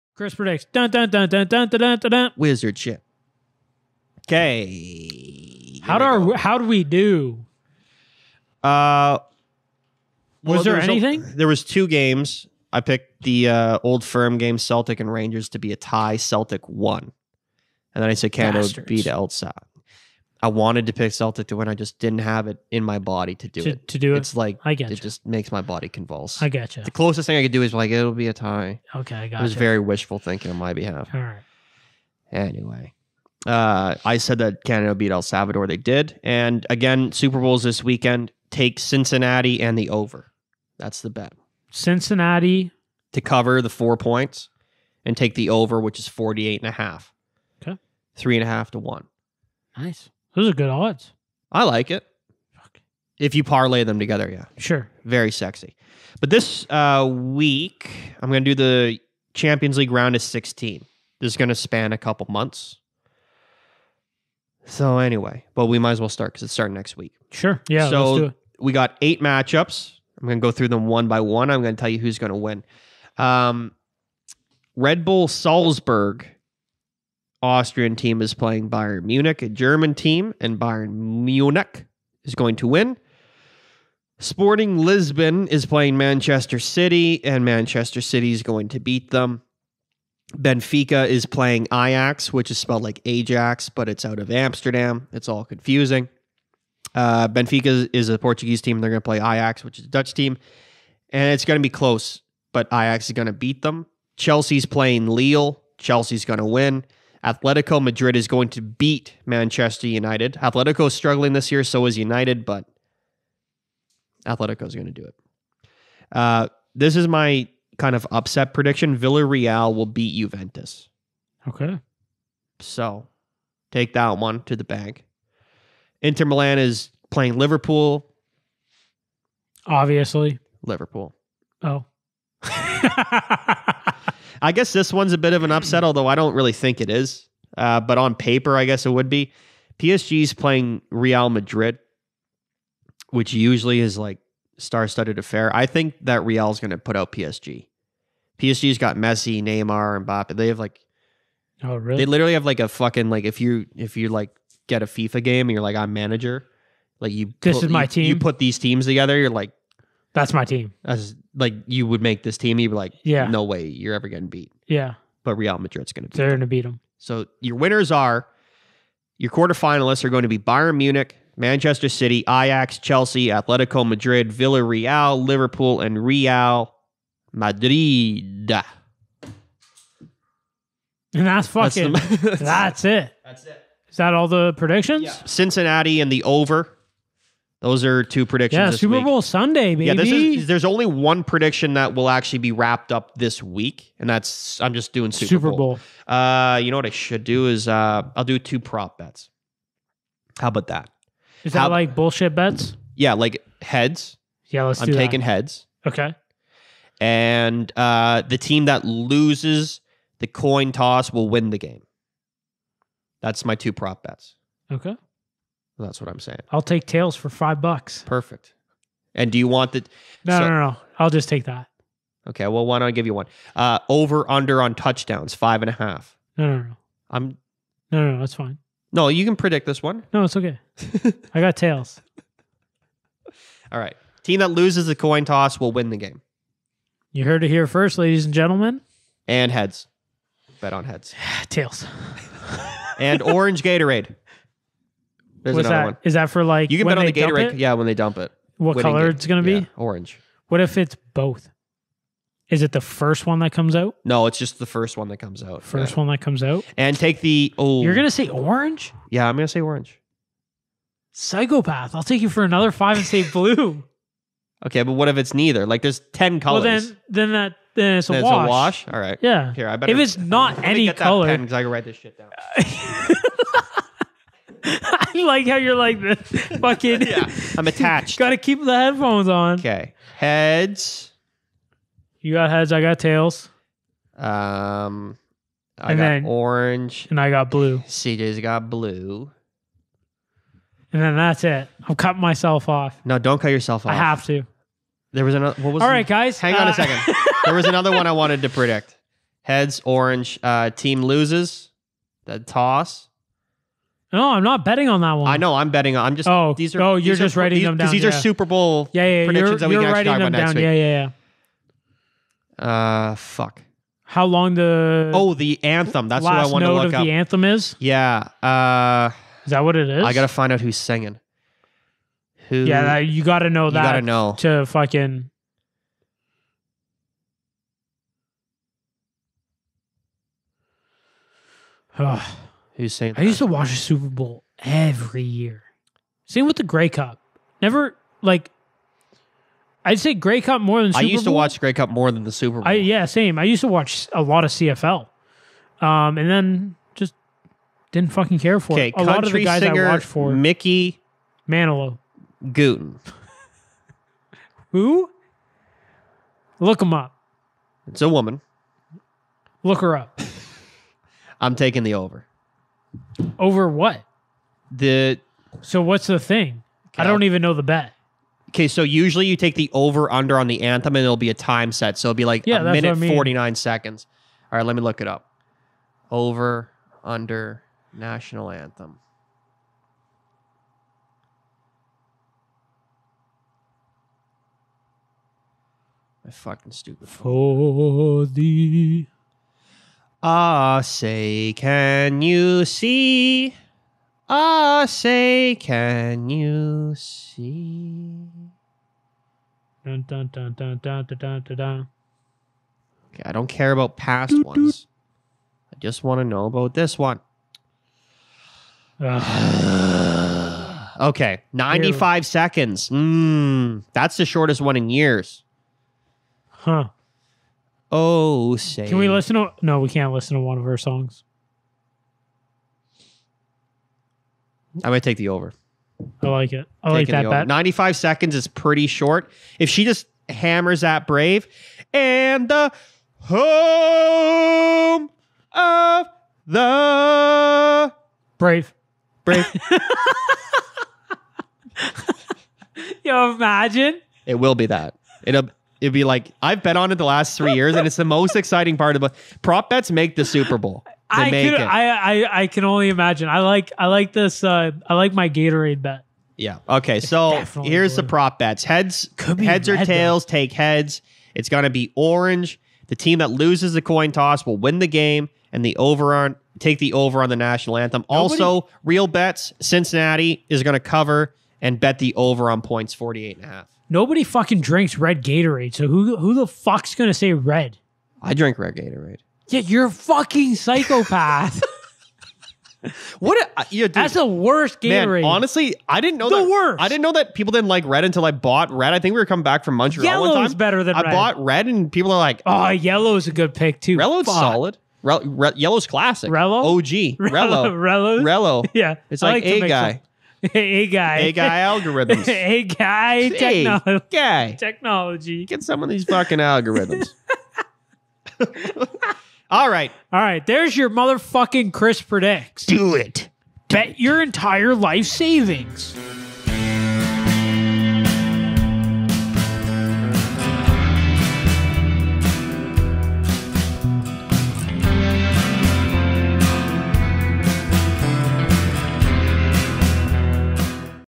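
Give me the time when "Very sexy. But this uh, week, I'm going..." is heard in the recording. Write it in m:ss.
0:55.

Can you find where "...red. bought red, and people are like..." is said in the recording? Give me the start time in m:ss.
8:11.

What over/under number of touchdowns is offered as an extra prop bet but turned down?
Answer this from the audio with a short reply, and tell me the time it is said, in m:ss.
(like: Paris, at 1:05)
5.5, at 3:45.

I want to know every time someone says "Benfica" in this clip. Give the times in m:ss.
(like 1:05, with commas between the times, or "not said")
1:30, 1:37.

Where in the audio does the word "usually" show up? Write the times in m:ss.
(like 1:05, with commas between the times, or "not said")
2:23, 6:08.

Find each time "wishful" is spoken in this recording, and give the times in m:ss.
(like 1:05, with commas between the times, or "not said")
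0:29.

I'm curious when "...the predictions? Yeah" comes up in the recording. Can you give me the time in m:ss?
3:04.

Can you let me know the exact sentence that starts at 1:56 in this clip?
Uh, this is my kind of upset prediction.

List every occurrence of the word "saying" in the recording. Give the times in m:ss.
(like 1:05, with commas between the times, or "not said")
3:36, 5:32.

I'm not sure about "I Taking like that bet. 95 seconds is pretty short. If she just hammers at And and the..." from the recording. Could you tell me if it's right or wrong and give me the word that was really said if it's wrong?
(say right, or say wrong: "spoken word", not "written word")
wrong: "Brave", not "And".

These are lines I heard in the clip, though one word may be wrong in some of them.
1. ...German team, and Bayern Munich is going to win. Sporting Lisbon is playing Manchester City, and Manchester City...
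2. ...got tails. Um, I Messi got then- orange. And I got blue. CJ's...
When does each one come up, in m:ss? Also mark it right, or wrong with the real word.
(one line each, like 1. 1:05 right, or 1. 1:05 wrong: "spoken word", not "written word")
1. 1:19 right
2. 4:42 wrong: "And", not "Messi".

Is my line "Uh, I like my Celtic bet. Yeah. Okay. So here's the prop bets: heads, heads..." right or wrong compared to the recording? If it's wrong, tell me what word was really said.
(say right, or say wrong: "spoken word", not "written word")
wrong: "Gatorade", not "Celtic".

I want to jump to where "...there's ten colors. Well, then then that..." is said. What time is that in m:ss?
4:25.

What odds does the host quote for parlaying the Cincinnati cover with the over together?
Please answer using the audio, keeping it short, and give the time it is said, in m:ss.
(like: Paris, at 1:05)
3.5 to 1, at 0:48.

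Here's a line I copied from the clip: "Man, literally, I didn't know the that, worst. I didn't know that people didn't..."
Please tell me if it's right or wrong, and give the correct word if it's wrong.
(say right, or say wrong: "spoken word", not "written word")
wrong: "honestly", not "literally".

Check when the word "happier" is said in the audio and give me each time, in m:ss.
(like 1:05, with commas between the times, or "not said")
not said.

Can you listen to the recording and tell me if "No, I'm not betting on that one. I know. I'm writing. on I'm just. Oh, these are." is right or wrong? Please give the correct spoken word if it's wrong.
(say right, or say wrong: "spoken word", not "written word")
wrong: "betting", not "writing".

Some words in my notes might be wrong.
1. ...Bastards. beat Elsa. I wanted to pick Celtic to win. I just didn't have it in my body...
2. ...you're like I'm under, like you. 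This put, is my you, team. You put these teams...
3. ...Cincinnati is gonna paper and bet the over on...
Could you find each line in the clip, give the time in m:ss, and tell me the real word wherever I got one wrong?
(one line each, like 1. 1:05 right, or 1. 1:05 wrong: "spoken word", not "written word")
1. 0:18 right
2. 2:35 wrong: "manager", not "under"
3. 7:49 wrong: "cover", not "paper".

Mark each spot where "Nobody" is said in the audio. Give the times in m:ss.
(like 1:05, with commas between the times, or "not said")
7:48, 7:53.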